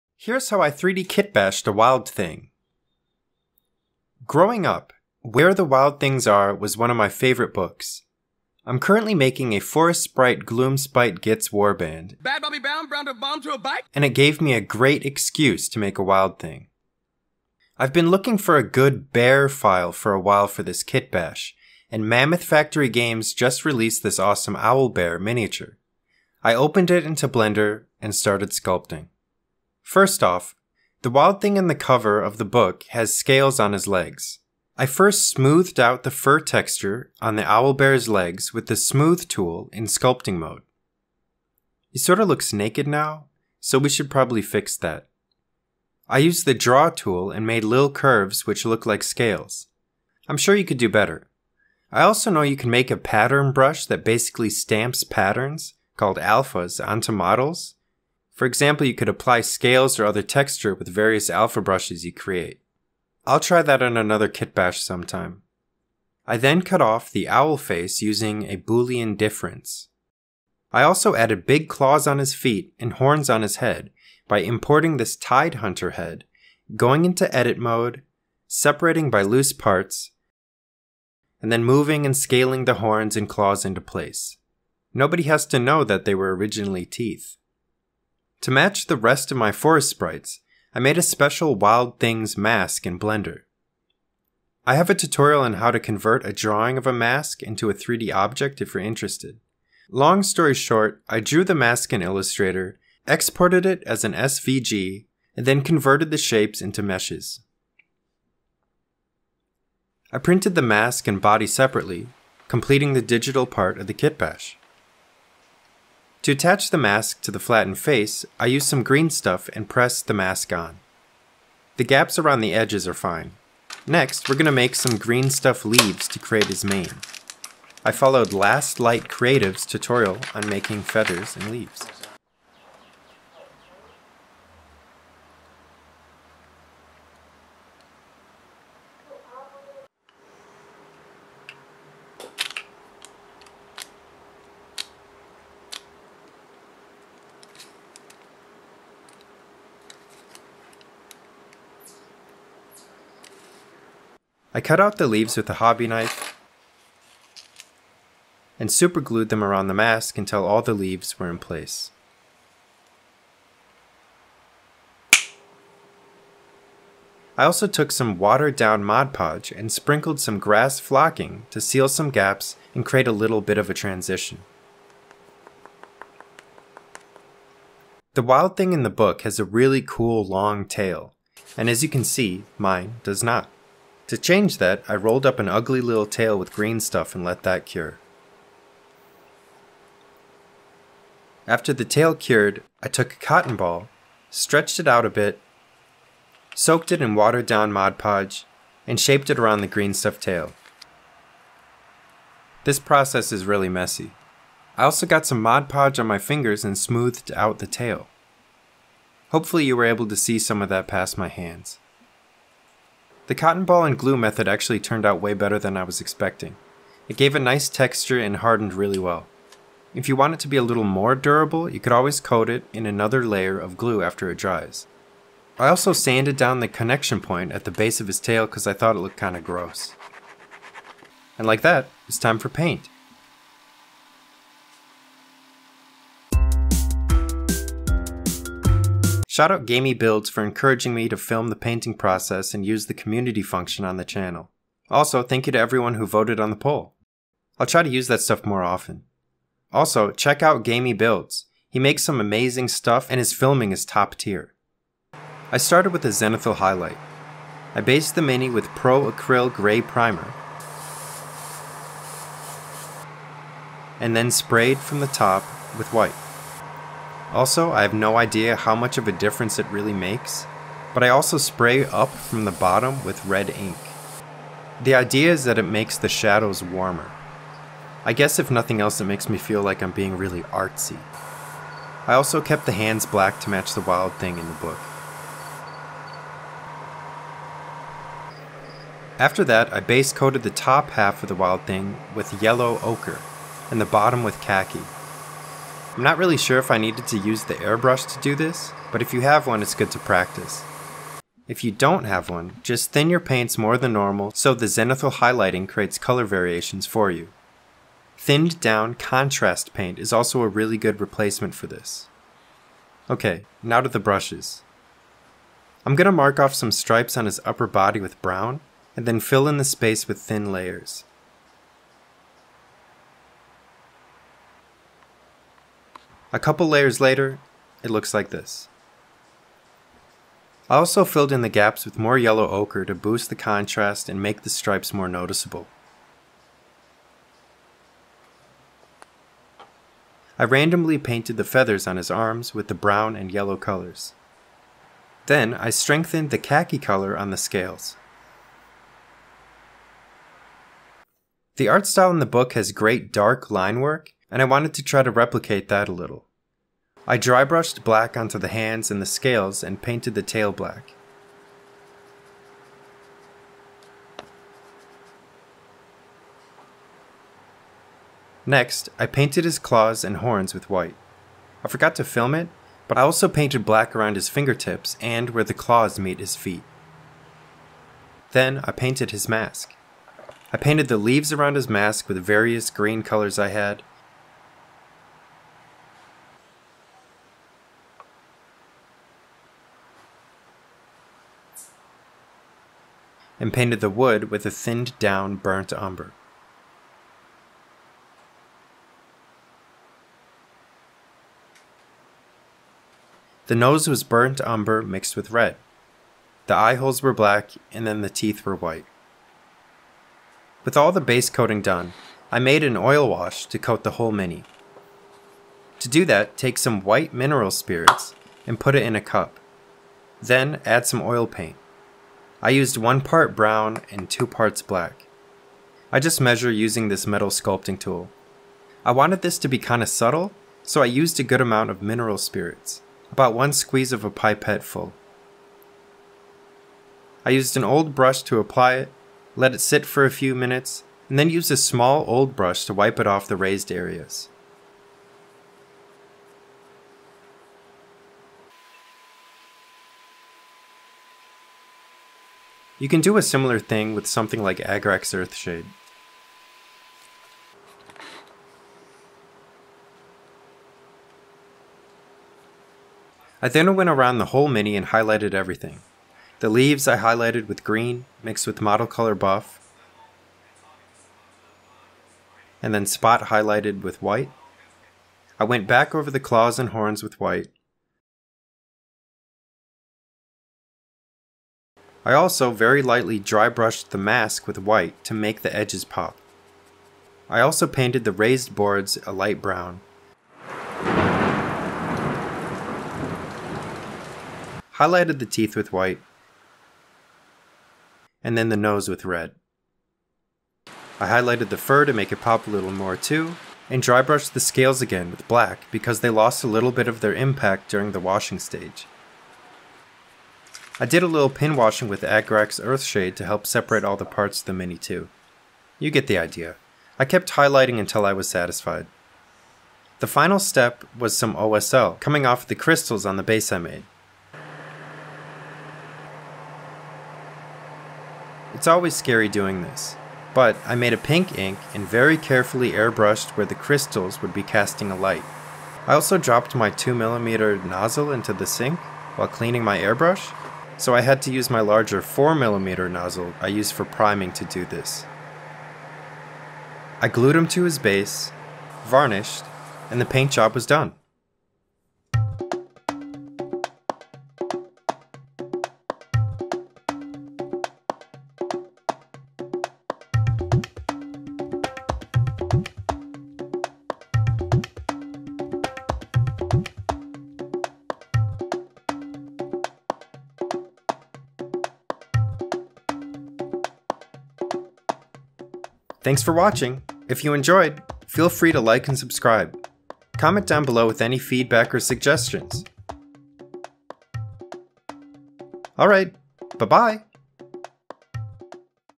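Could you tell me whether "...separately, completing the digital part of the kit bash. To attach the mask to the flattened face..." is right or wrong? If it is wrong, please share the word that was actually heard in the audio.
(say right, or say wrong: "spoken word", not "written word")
right.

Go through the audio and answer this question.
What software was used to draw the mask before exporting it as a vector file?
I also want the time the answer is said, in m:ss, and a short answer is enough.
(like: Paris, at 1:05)
Illustrator, at 1:42.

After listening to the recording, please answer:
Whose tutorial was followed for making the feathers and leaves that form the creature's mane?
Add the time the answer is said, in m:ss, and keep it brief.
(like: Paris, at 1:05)
Last Light Creative, at 2:08.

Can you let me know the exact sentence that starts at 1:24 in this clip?
Nobody has to know that they were originally teeth.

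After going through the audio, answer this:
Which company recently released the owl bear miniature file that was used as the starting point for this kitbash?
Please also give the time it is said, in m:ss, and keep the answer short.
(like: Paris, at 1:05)
Mammoth Factory Games, at 0:22.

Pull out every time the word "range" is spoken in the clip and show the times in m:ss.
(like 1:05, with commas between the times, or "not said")
not said.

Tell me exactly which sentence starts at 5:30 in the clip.
I also filled in the gaps with more yellow ochre to boost the contrast and make the stripes more noticeable.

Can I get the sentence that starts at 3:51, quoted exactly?
And like that, it's time for paint.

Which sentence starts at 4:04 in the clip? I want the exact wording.
Also, thank you to everyone who voted on the poll.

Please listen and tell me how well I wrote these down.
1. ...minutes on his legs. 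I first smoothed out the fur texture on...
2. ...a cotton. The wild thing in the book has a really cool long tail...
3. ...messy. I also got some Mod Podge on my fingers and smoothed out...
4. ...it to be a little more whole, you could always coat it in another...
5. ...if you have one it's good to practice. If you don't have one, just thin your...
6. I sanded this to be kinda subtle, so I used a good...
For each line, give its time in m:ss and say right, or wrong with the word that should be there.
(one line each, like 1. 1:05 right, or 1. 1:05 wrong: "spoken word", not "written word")
1. 0:33 wrong: "scales", not "minutes"
2. 2:53 wrong: "transition", not "cotton"
3. 3:23 right
4. 3:40 wrong: "durable", not "whole"
5. 4:59 right
6. 7:08 wrong: "wanted", not "sanded".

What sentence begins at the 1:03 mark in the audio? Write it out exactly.
I'll try that on another kitbash sometime.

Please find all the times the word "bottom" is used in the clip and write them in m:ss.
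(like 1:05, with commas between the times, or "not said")
4:32, 4:53.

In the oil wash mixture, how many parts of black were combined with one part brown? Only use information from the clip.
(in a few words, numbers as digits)
2.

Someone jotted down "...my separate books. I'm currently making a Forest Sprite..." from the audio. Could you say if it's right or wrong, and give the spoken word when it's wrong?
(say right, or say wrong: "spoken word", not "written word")
wrong: "favorite", not "separate".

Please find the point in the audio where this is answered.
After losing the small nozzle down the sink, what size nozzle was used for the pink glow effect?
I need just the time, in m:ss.
9:02.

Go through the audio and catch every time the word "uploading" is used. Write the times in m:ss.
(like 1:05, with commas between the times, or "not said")
not said.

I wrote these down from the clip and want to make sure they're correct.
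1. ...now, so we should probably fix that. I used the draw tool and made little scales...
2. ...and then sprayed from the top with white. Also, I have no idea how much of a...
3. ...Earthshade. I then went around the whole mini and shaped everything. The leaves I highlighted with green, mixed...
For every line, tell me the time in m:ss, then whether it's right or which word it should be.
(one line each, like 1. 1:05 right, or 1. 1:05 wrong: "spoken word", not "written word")
1. 0:42 wrong: "curves", not "scales"
2. 4:23 right
3. 7:35 wrong: "highlighted", not "shaped".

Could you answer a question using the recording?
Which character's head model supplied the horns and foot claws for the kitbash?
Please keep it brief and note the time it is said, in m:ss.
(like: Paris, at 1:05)
Tide Hunter, at 1:15.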